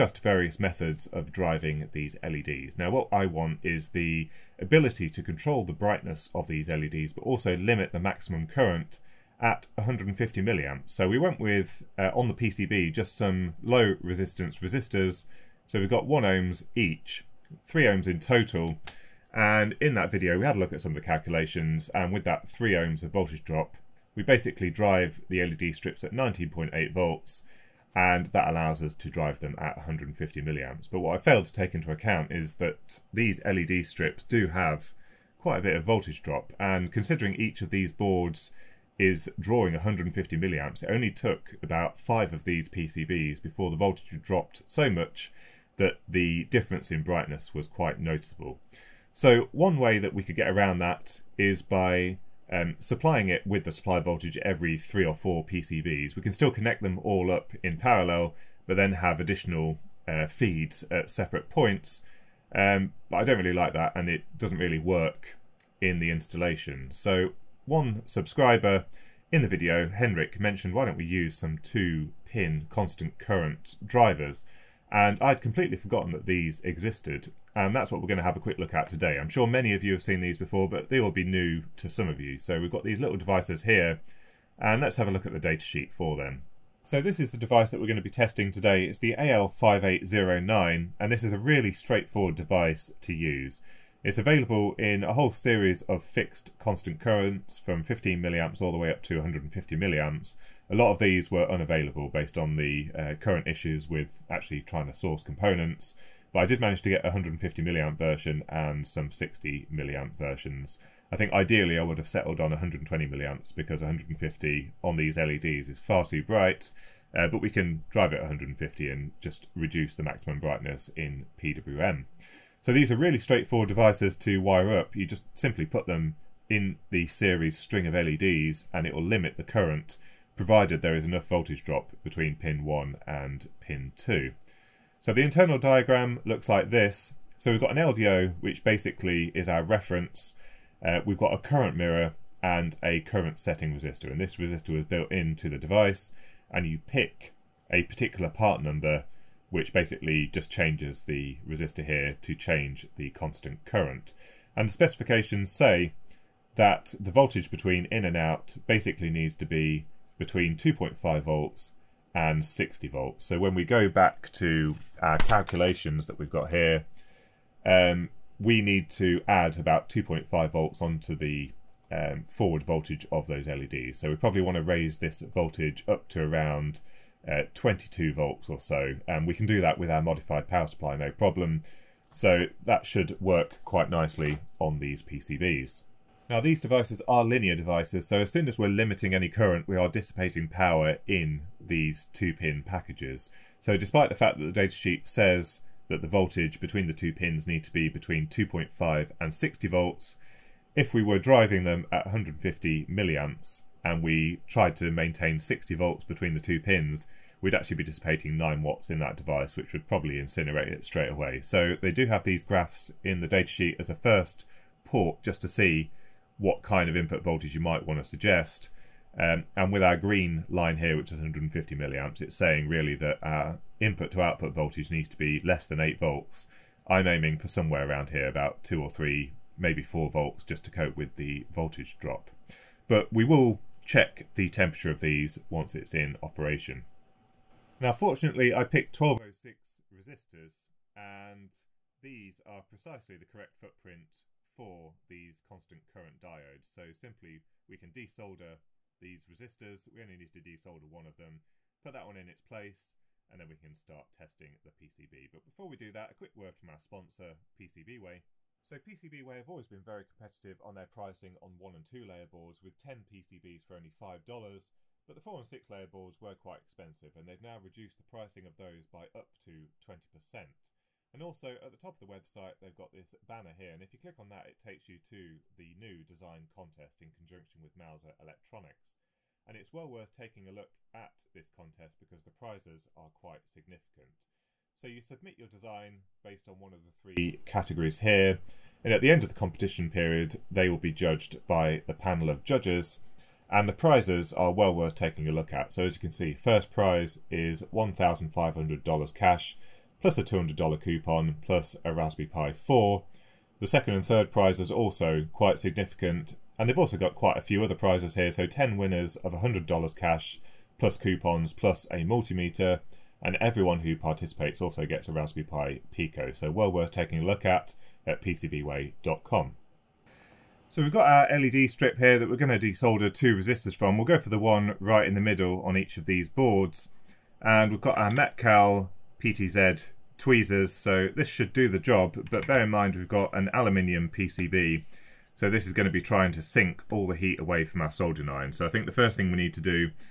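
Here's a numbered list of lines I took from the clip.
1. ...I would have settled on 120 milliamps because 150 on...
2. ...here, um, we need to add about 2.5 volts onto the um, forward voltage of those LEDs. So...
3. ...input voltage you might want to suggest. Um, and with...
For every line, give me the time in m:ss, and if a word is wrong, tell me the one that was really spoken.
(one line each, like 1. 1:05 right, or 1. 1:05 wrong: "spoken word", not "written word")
1. 1:51 right
2. 2:46 right
3. 3:36 right.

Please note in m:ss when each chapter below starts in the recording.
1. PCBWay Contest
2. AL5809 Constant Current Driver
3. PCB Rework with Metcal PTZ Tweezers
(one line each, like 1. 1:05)
1. 4:17
2. 1:25
3. 5:19.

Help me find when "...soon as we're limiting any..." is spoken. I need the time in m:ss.
3:08.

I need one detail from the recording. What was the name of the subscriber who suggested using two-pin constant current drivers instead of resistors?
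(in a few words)
Henrik.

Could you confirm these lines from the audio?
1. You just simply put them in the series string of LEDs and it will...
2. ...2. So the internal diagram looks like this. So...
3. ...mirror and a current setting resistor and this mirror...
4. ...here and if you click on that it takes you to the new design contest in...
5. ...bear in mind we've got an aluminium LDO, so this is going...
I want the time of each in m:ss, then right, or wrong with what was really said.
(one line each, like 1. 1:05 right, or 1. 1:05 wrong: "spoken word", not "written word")
1. 2:04 right
2. 2:13 right
3. 2:21 wrong: "resistor", not "mirror"
4. 4:33 right
5. 5:32 wrong: "PCB", not "LDO".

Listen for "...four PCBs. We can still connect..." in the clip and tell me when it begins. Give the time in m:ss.
0:55.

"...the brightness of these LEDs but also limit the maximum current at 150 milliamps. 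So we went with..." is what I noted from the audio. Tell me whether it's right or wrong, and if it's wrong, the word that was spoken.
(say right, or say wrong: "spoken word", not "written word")
right.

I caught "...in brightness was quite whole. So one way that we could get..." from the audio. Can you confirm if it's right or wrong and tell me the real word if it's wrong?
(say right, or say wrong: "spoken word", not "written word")
wrong: "noticeable", not "whole".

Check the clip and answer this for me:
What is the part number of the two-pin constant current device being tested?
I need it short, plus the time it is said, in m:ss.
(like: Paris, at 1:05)
AL5809, at 1:29.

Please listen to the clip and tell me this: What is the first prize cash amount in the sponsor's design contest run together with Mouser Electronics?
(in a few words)
$1,500.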